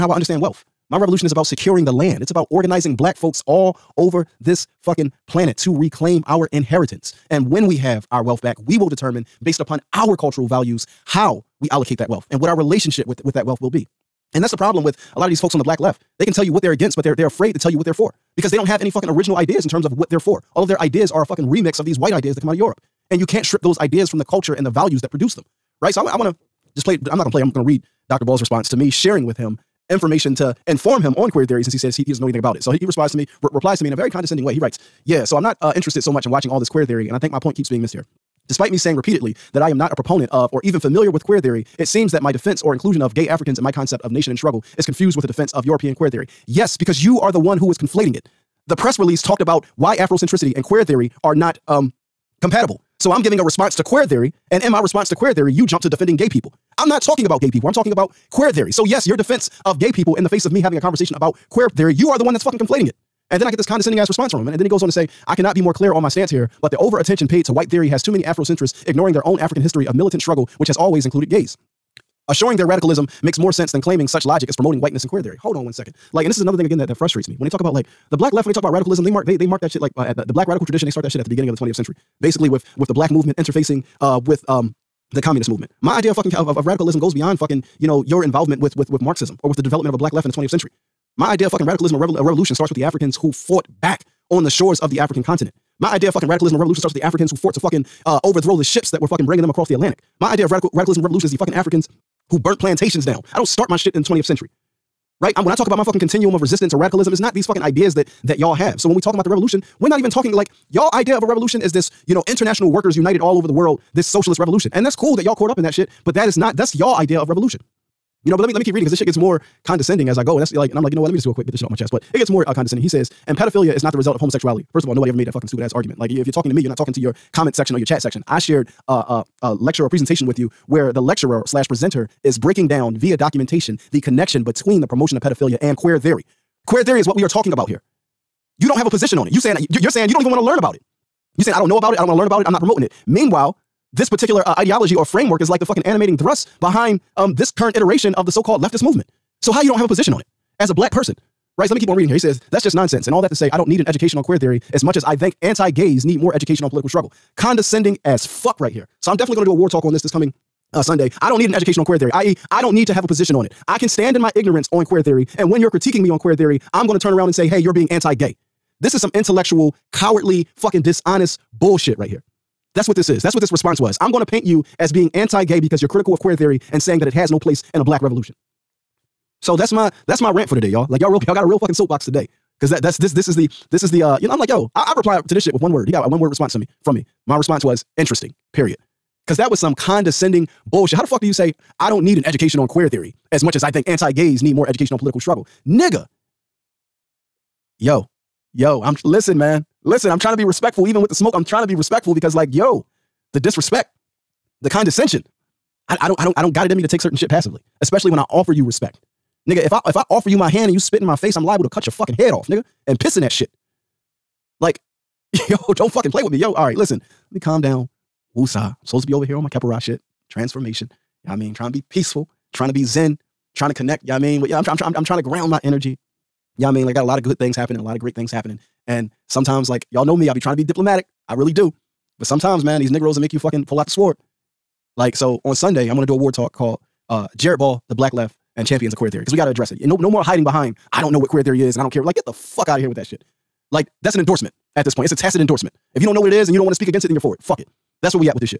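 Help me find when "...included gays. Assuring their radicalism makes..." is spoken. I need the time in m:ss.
1:11.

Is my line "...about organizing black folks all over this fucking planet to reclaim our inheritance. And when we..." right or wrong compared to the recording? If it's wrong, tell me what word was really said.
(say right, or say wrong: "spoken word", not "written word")
right.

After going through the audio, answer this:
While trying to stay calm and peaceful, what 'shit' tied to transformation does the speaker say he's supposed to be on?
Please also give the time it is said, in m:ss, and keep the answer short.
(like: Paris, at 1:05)
Kepara, at 3:39.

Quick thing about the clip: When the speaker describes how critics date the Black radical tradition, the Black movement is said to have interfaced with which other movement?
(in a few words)
communist movement.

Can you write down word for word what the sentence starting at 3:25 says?
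I, I don't I don't I don't got it in me to take certain shit passively, especially when I offer you respect.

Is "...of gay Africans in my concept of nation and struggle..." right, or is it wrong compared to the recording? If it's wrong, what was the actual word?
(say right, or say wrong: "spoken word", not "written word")
right.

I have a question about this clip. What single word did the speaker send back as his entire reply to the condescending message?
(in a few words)
Interesting.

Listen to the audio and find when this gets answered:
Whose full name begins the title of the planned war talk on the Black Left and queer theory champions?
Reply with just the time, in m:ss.
3:57.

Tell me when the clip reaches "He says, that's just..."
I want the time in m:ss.
2:32.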